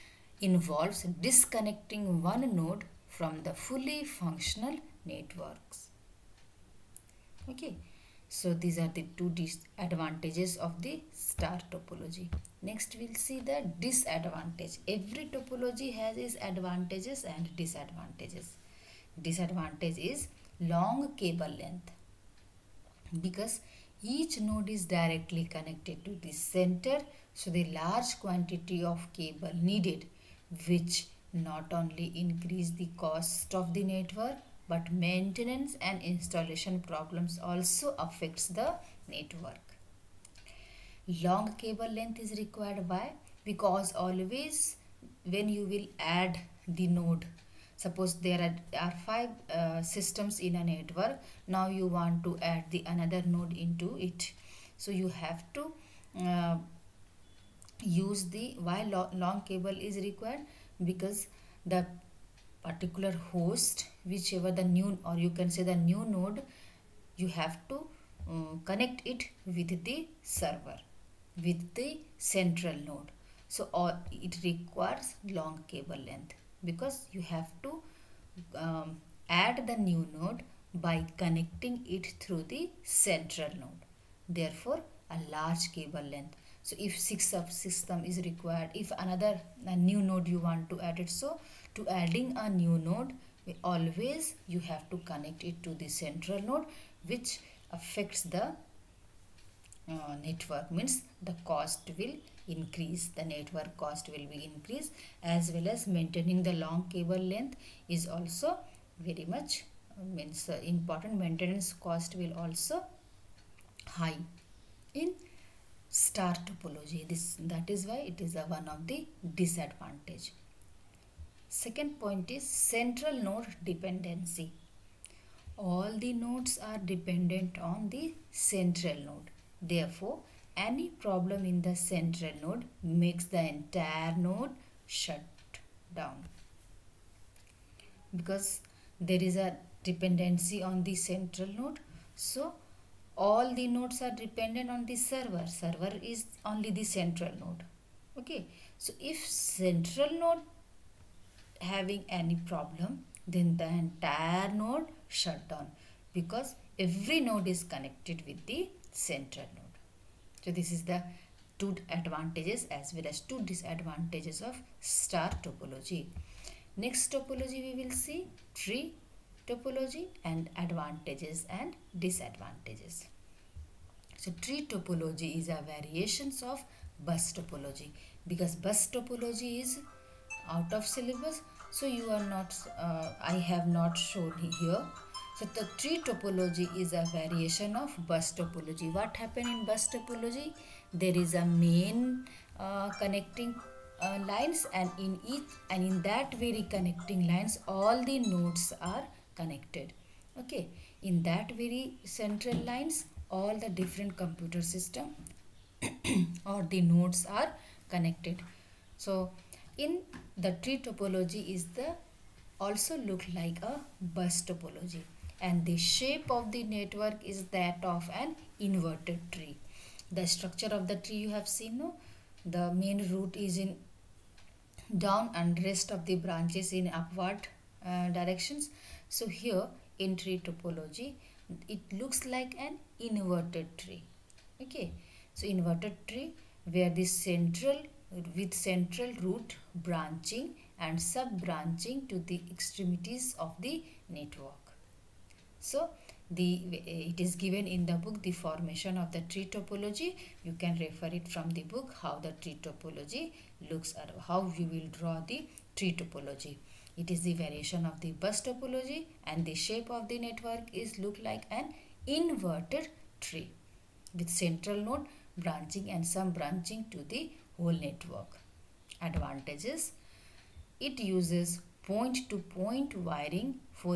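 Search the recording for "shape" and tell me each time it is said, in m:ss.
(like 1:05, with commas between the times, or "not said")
3:35, 4:19.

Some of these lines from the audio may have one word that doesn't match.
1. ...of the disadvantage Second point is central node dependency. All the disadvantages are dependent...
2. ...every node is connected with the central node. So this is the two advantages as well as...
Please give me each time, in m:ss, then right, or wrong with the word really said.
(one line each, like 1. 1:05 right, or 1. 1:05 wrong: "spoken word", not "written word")
1. 1:58 wrong: "nodes", not "disadvantages"
2. 2:36 right.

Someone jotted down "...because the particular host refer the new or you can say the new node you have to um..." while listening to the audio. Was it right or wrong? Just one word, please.
wrong.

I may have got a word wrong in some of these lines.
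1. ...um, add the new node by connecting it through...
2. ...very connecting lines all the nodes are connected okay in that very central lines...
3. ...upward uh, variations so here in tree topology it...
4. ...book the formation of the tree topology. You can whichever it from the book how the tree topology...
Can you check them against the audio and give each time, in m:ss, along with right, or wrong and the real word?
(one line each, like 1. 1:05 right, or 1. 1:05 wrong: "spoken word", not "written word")
1. 1:18 right
2. 3:16 right
3. 3:47 wrong: "directions", not "variations"
4. 4:07 wrong: "refer", not "whichever".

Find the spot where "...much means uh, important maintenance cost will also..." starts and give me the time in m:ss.
1:49.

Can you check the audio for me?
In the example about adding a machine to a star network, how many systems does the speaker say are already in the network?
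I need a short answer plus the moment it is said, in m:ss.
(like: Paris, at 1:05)
5, at 0:49.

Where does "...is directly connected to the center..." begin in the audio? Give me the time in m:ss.
0:24.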